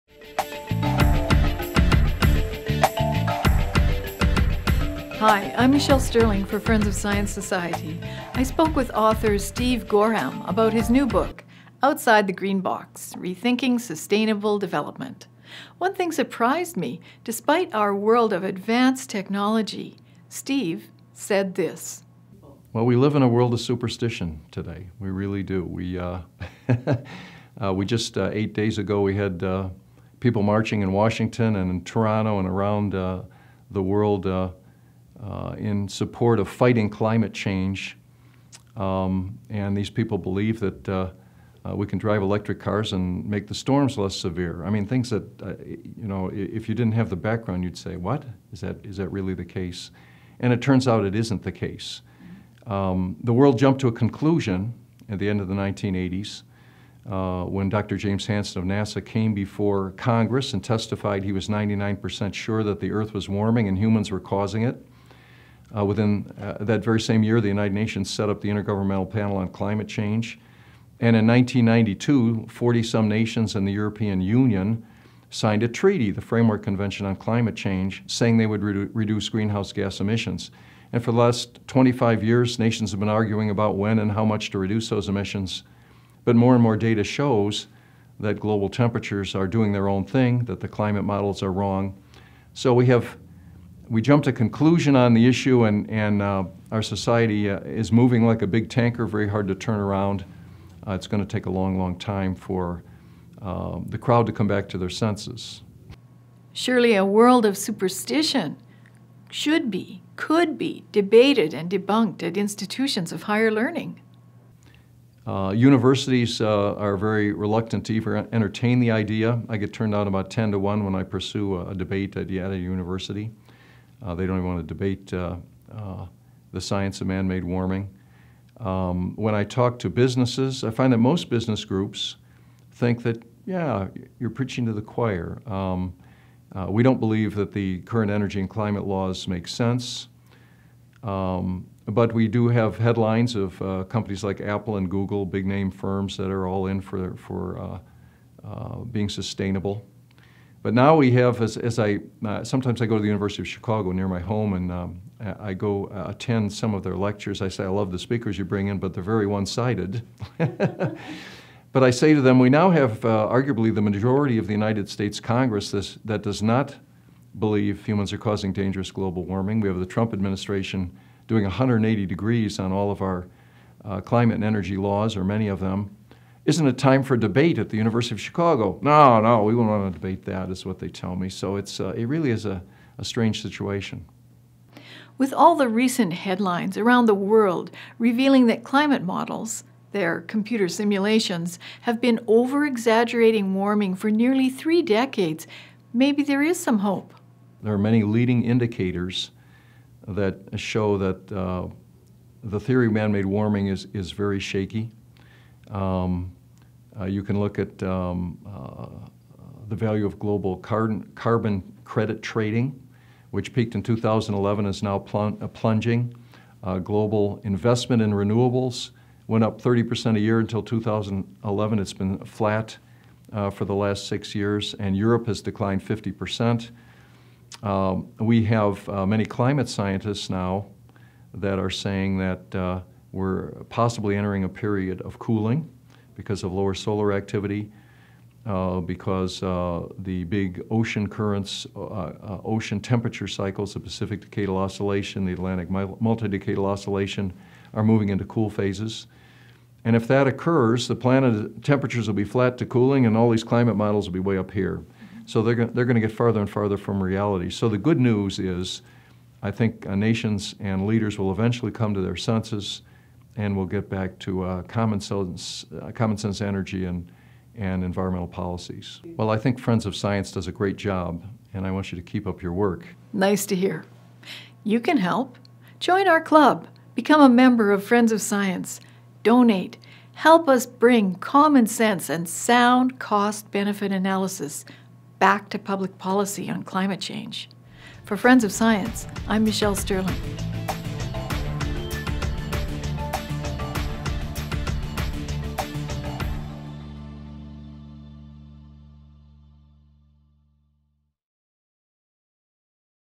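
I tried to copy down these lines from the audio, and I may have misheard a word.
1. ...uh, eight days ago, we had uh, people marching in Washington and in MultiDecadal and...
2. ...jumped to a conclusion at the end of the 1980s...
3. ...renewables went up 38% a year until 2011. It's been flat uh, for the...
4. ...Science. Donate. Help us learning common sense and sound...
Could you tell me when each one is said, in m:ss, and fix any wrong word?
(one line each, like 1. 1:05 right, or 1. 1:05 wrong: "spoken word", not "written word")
1. 0:28 wrong: "Toronto", not "MultiDecadal"
2. 0:53 right
3. 3:38 wrong: "30", not "38"
4. 4:38 wrong: "bring", not "learning".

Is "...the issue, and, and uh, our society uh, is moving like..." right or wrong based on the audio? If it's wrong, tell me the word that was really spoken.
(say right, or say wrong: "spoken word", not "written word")
right.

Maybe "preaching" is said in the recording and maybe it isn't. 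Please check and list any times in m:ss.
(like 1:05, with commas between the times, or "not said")
2:14.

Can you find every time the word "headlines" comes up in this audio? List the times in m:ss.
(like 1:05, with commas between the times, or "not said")
2:22, 3:06.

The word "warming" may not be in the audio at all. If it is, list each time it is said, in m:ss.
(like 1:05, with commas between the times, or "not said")
1:03, 2:07, 2:49, 3:13, 3:23.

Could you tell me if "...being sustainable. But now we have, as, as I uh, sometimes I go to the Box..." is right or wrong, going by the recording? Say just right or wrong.
wrong.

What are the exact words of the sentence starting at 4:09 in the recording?
And if that occurs, the planet temperatures will be flat to cooling and all these climate models will be way up here.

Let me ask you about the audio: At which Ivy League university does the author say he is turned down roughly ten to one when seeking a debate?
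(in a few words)
Yale University.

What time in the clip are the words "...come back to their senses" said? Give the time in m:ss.
1:44.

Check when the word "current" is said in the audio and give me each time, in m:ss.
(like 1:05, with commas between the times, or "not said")
2:17, 4:01.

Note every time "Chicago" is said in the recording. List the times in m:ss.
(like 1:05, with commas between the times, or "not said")
2:33, 2:58.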